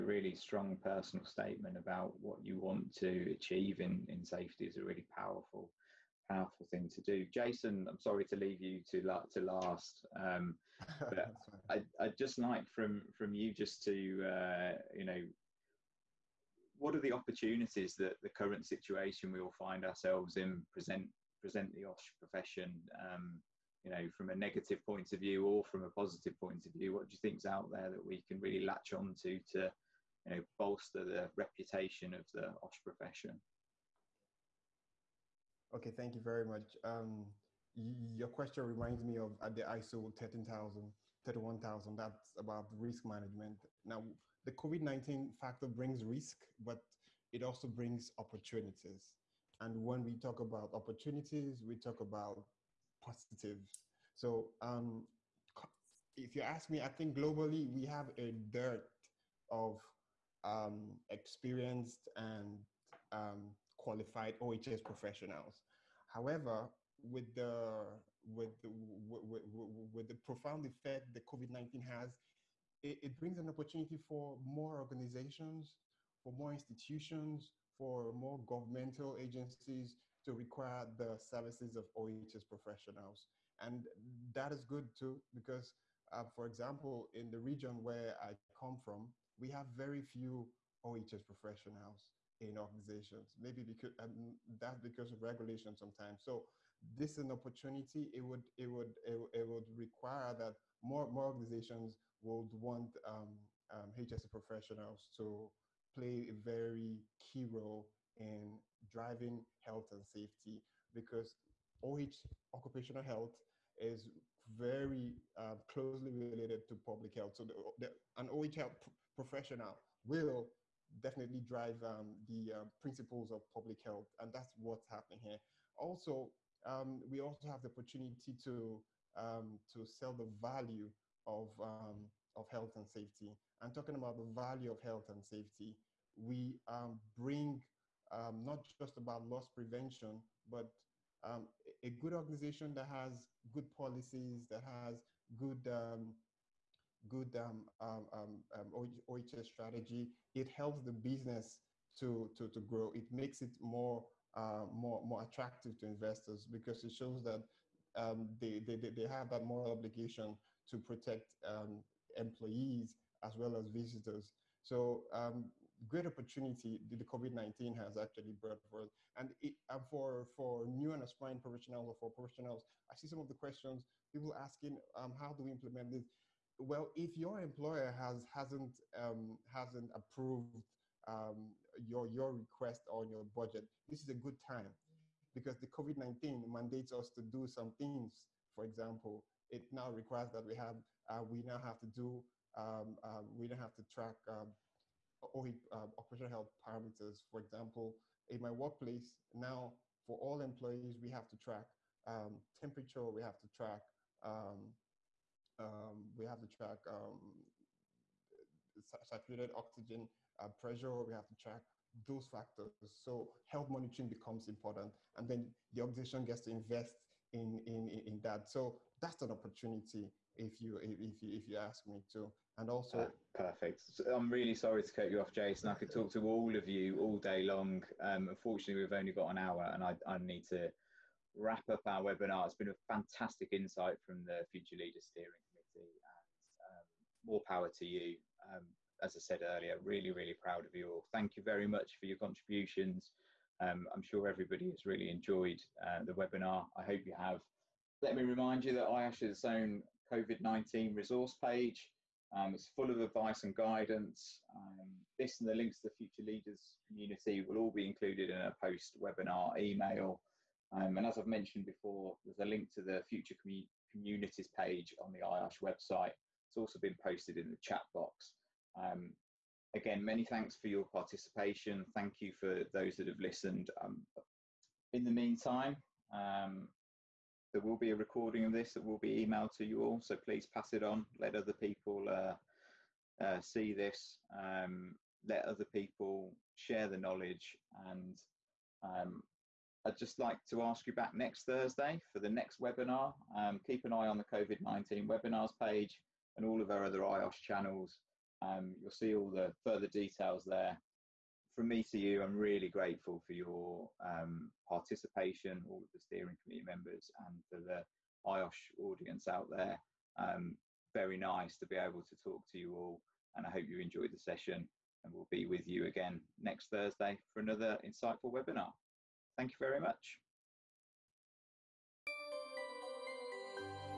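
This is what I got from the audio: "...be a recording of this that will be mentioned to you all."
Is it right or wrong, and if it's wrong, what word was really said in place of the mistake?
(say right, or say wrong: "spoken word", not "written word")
wrong: "emailed", not "mentioned".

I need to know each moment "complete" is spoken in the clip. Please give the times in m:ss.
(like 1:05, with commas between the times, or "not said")
not said.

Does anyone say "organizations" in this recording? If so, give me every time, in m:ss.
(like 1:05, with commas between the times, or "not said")
1:14, 1:32, 1:41, 2:22, 3:35.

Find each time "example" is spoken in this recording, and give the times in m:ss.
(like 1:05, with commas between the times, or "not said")
1:26, 3:08, 3:17.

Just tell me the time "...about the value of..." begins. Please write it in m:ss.
2:13.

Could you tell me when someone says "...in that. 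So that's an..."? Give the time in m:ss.
3:37.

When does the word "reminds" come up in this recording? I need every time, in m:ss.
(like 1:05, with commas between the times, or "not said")
0:38, 4:08.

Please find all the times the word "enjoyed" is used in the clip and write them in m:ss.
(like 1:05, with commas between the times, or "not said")
4:05, 5:13.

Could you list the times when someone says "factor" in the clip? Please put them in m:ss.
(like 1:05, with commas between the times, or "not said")
0:45, 3:32.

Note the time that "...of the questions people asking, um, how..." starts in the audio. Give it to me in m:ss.
2:53.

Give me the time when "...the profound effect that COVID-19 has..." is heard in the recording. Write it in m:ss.
1:10.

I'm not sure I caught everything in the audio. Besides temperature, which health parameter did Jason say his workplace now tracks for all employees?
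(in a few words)
Saturated oxygen.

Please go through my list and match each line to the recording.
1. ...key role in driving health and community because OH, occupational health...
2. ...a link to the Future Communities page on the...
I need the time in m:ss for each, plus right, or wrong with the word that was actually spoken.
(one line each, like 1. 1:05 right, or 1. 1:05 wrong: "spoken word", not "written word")
1. 1:47 wrong: "safety", not "community"
2. 4:22 right.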